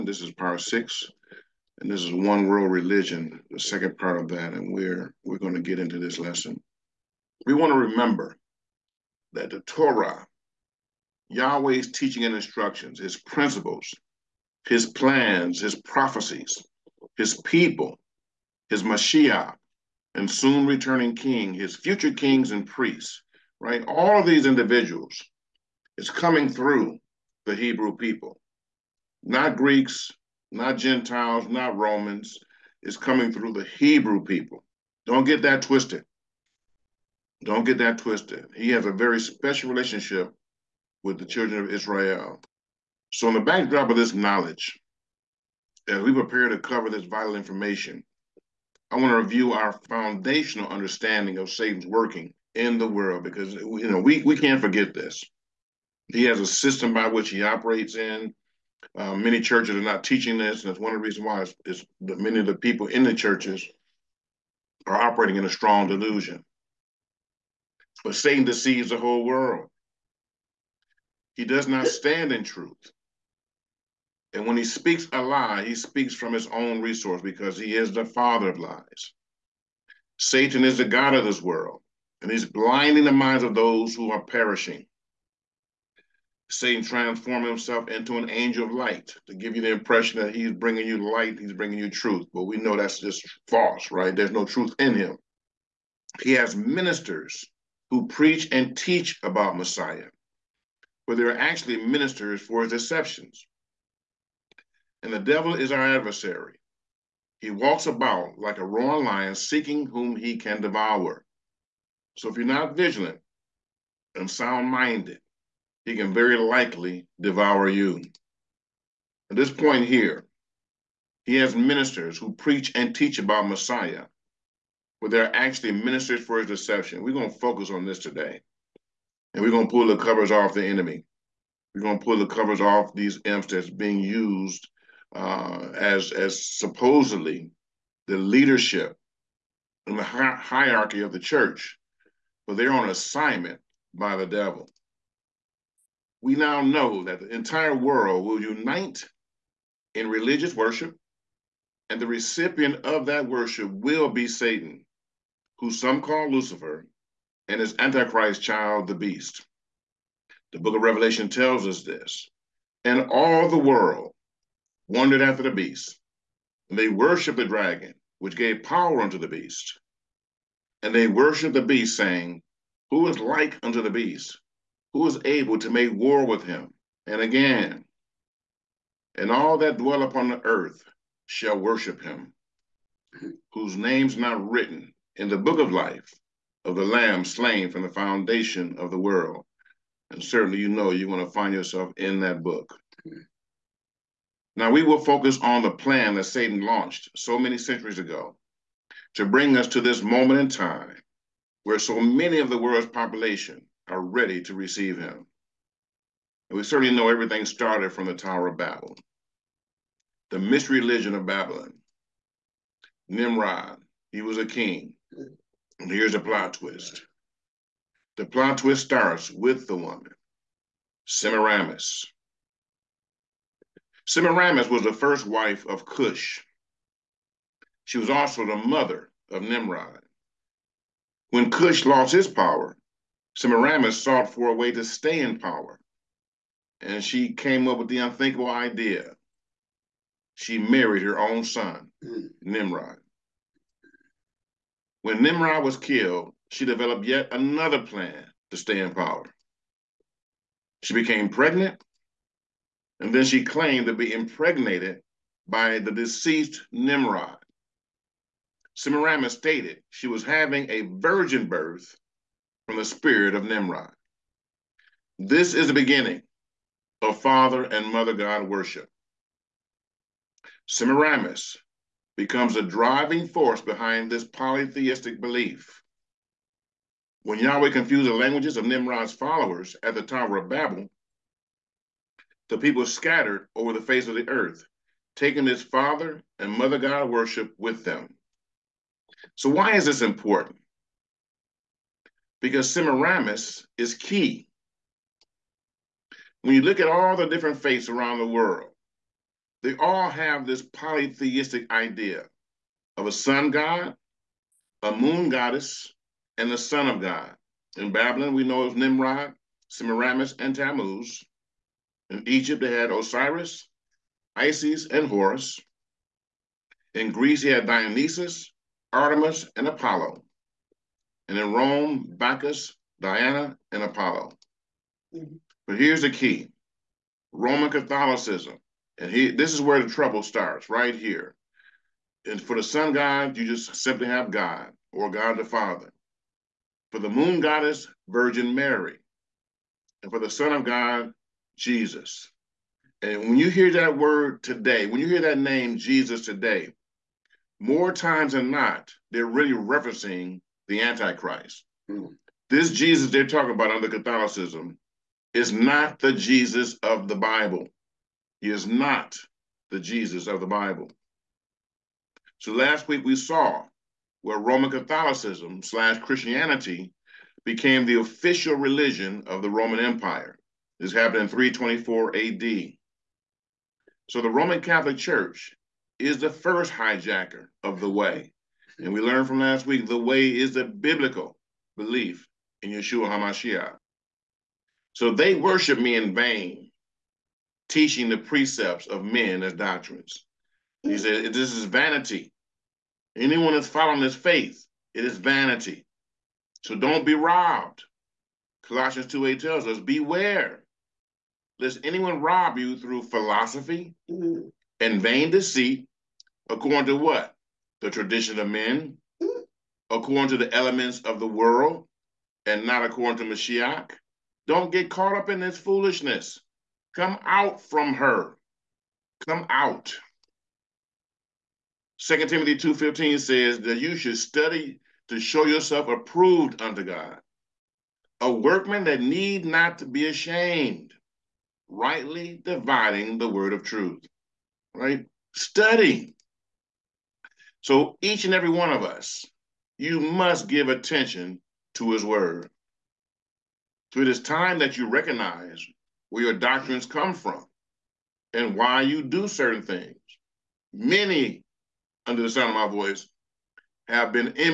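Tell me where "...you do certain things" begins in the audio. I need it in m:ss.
7:28.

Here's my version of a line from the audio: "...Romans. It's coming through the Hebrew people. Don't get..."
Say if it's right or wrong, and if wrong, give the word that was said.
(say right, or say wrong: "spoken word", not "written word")
right.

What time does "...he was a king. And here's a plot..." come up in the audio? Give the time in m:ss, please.
3:34.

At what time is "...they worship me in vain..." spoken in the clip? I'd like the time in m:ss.
6:25.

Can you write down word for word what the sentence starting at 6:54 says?
Don't get caught up in this foolishness.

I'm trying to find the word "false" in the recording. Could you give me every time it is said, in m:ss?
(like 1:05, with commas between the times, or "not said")
1:33.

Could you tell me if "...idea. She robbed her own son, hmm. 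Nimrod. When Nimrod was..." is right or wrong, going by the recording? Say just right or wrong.
wrong.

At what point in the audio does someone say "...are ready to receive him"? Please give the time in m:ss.
3:23.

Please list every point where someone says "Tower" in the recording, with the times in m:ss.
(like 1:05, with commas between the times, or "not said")
3:28, 4:40.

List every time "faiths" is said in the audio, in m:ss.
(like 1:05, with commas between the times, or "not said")
4:57, 6:34.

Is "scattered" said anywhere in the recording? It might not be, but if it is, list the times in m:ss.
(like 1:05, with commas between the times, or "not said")
4:42.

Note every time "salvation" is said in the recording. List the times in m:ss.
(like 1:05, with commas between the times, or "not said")
not said.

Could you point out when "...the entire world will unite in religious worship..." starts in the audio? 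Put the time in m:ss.
2:27.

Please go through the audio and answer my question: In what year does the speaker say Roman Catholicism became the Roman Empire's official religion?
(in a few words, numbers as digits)
324 AD.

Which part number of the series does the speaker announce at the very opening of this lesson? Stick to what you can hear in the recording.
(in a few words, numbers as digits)
Part six.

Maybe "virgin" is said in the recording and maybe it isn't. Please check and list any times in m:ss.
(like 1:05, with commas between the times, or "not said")
4:20, 5:38.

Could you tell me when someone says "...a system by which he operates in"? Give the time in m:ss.
0:56.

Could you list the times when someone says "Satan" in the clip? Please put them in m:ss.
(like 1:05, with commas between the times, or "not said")
0:51, 1:08, 1:20, 1:26, 2:34, 3:16.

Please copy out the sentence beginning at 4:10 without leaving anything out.
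She became pregnant, and then she claimed to be impregnated by the deceased Nimrod.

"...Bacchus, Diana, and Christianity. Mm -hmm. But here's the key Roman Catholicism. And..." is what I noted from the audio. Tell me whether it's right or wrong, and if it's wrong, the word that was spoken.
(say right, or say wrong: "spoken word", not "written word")
wrong: "Apollo", not "Christianity".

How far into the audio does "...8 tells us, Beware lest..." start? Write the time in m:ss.
6:39.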